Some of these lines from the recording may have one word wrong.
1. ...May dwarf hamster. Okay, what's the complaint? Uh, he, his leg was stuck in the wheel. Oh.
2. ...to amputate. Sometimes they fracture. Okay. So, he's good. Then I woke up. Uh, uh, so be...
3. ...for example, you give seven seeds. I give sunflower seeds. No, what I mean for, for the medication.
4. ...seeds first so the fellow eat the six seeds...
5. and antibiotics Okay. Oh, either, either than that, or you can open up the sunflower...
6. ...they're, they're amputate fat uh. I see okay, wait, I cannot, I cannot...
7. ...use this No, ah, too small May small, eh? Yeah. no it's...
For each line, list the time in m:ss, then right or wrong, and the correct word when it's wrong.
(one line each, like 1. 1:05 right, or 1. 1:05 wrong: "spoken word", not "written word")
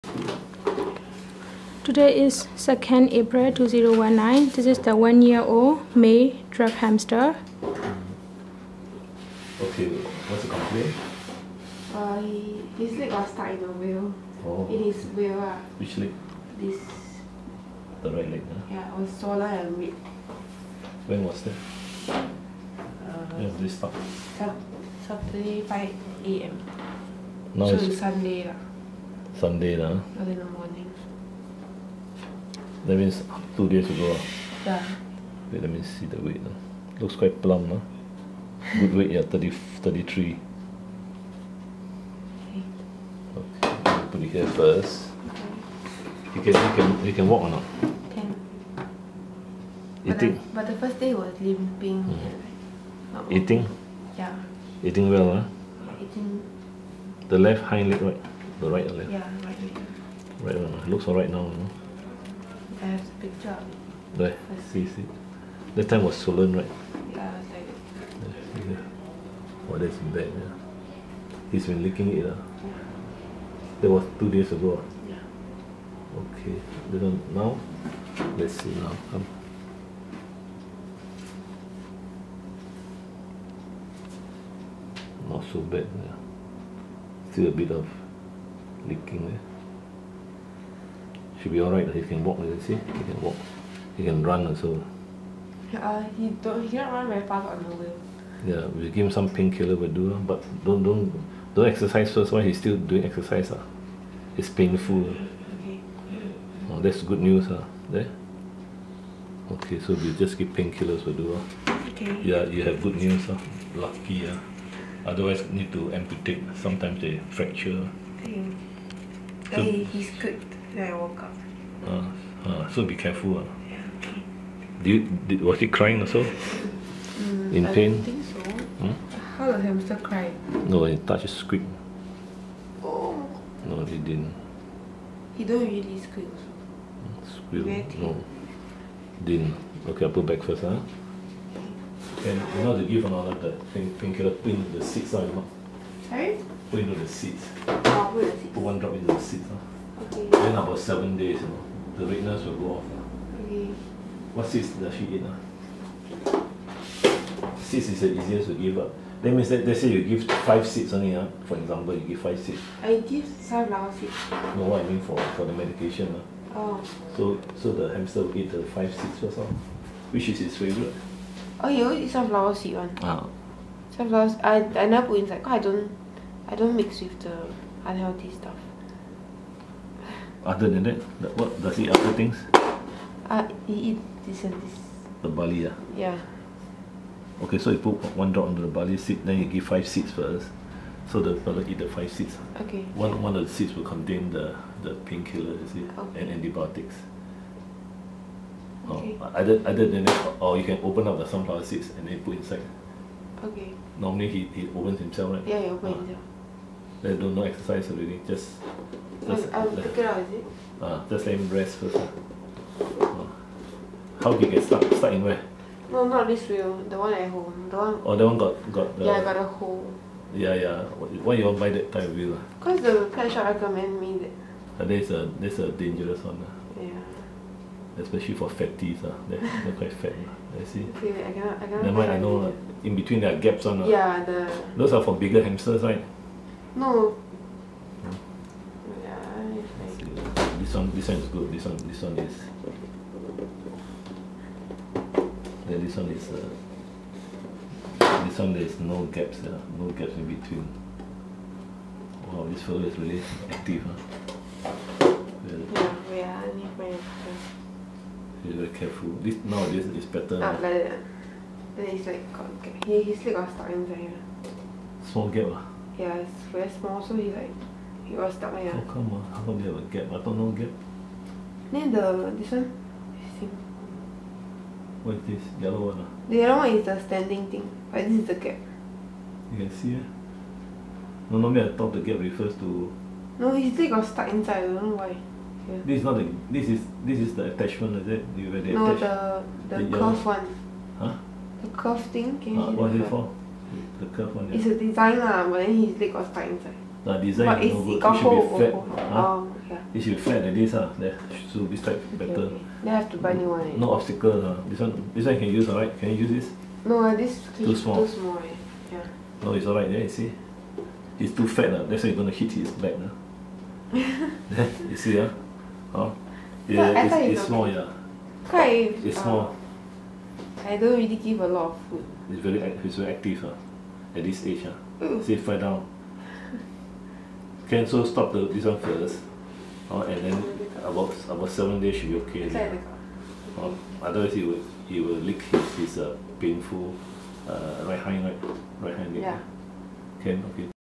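1. 0:05 right
2. 1:55 right
3. 2:41 wrong: "five", not "seven"
4. 3:09 wrong: "five", not "six"
5. 3:16 right
6. 3:49 wrong: "quite", not "amputate"
7. 5:06 wrong: "Too", not "May".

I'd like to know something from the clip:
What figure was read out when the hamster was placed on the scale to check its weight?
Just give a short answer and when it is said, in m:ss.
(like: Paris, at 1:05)
33, at 0:39.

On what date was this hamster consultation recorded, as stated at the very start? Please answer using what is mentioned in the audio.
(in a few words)
2nd April 2019.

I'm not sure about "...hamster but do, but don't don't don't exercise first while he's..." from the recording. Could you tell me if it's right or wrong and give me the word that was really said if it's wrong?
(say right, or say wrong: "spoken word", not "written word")
wrong: "painkiller", not "hamster".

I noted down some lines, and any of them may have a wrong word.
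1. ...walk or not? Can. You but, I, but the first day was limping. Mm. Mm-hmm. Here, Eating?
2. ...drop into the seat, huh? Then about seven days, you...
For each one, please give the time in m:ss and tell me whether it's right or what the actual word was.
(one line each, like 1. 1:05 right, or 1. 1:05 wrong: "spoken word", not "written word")
1. 0:47 right
2. 2:28 right.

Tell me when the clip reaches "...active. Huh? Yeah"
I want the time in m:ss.
4:13.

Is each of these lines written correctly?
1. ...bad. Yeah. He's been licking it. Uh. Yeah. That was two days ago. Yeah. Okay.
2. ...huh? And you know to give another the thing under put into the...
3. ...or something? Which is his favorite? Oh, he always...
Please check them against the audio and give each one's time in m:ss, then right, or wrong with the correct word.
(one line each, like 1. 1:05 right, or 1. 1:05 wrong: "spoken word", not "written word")
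1. 1:09 right
2. 2:20 wrong: "painkiller", not "under"
3. 2:49 right.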